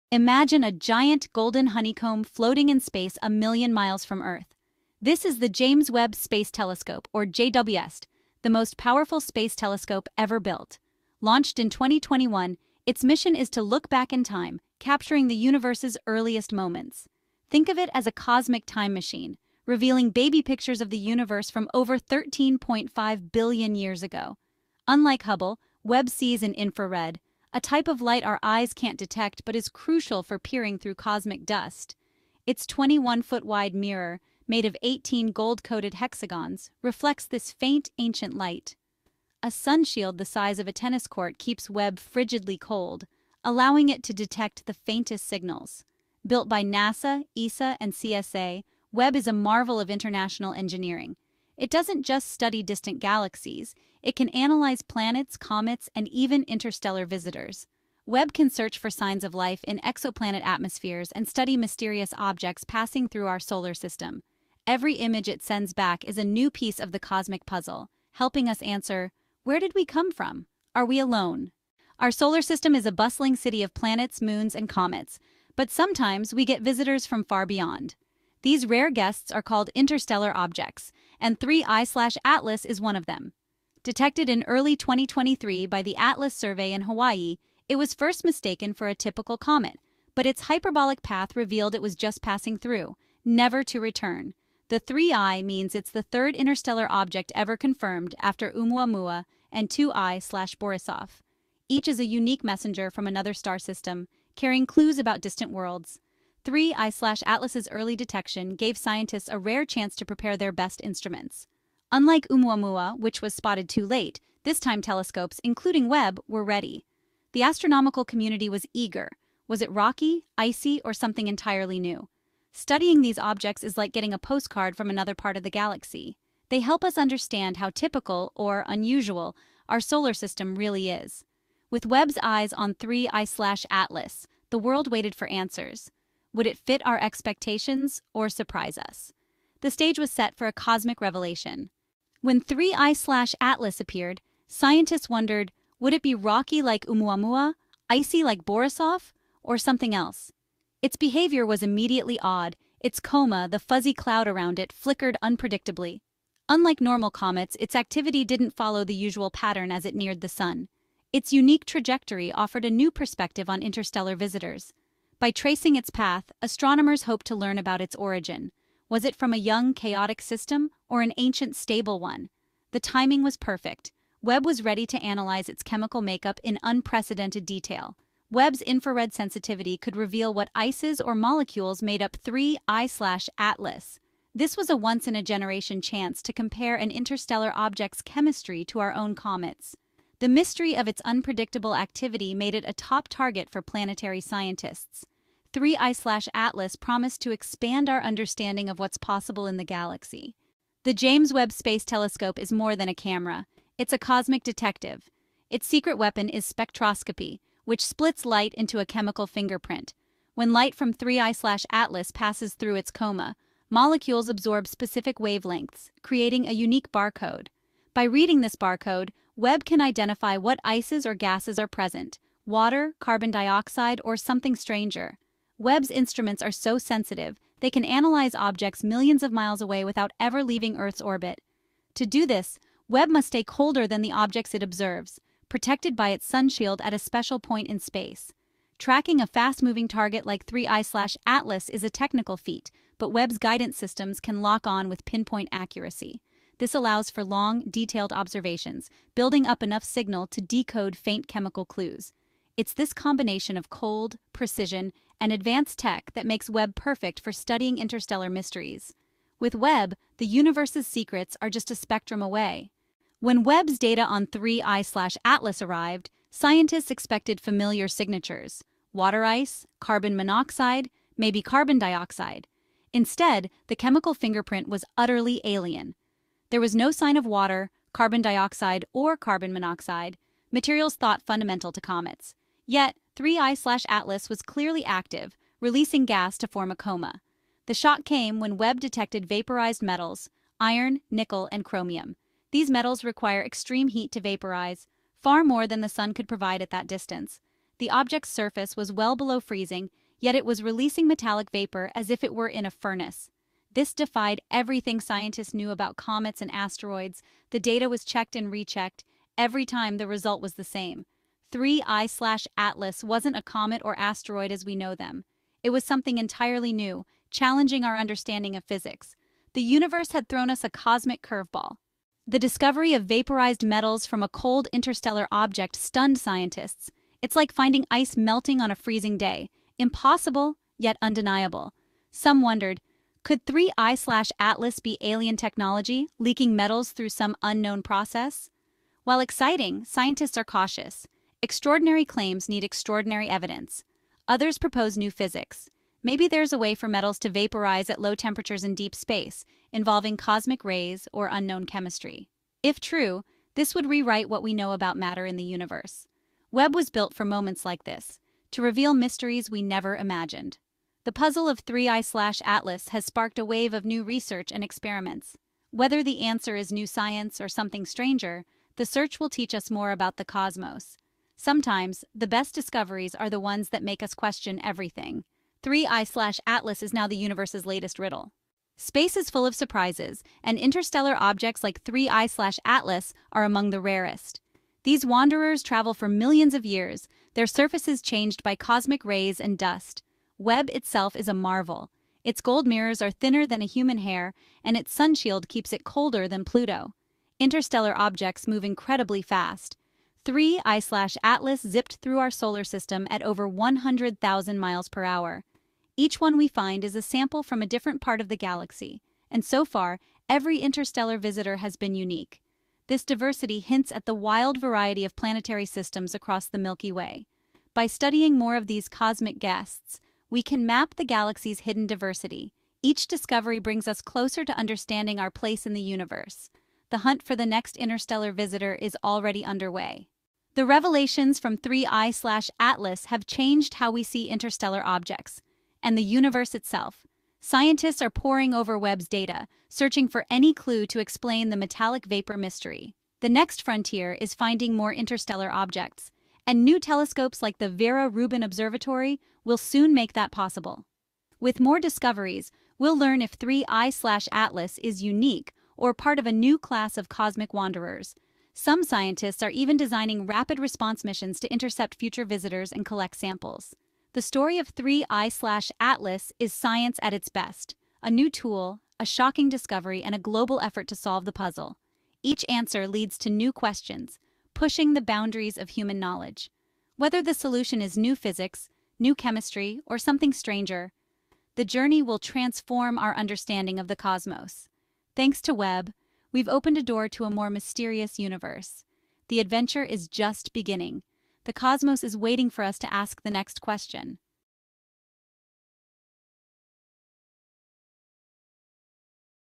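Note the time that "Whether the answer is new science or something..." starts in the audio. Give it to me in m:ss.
6:05.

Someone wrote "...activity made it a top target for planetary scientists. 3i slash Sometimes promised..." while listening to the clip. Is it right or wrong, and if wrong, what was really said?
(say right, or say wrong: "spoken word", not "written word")
wrong: "Atlas", not "Sometimes".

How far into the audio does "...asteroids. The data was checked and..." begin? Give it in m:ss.
5:06.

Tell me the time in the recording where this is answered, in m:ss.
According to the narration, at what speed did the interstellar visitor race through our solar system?
6:43.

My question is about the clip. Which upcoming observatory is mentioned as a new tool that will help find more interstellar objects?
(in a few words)
Vera Rubin Observatory.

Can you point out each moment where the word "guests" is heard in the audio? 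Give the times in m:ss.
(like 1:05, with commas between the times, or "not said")
1:18, 6:59.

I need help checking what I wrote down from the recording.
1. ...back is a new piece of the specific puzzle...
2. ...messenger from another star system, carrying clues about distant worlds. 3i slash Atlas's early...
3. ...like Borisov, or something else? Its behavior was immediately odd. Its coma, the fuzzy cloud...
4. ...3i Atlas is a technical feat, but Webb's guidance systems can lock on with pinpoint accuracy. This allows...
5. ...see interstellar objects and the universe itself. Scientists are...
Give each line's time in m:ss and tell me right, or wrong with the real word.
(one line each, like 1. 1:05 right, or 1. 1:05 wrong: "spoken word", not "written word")
1. 1:05 wrong: "cosmic", not "specific"
2. 1:42 right
3. 2:28 right
4. 4:00 right
5. 7:14 right.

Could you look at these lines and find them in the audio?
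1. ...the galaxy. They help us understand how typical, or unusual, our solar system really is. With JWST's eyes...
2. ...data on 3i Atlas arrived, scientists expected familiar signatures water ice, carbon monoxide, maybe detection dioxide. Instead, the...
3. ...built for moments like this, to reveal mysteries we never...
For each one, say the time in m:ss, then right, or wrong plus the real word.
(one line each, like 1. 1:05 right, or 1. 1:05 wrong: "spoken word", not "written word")
1. 2:05 wrong: "Webb", not "JWST"
2. 4:23 wrong: "carbon", not "detection"
3. 5:56 right.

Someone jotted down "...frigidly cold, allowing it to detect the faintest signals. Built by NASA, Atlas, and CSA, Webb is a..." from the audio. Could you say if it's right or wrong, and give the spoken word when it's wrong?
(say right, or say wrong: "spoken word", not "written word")
wrong: "ESA", not "Atlas".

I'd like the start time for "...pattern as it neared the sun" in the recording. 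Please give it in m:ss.
2:39.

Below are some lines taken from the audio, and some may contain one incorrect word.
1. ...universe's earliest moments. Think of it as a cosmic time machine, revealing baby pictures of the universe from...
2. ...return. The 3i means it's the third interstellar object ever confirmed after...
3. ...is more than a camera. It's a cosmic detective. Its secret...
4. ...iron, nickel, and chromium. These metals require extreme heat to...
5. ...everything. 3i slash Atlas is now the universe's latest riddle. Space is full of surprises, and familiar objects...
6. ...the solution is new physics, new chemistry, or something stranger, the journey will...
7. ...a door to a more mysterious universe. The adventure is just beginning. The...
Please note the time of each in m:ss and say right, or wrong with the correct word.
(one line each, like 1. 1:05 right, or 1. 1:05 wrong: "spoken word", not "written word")
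1. 0:15 right
2. 1:33 right
3. 3:22 right
4. 4:50 right
5. 6:14 wrong: "interstellar", not "familiar"
6. 7:57 right
7. 8:06 right.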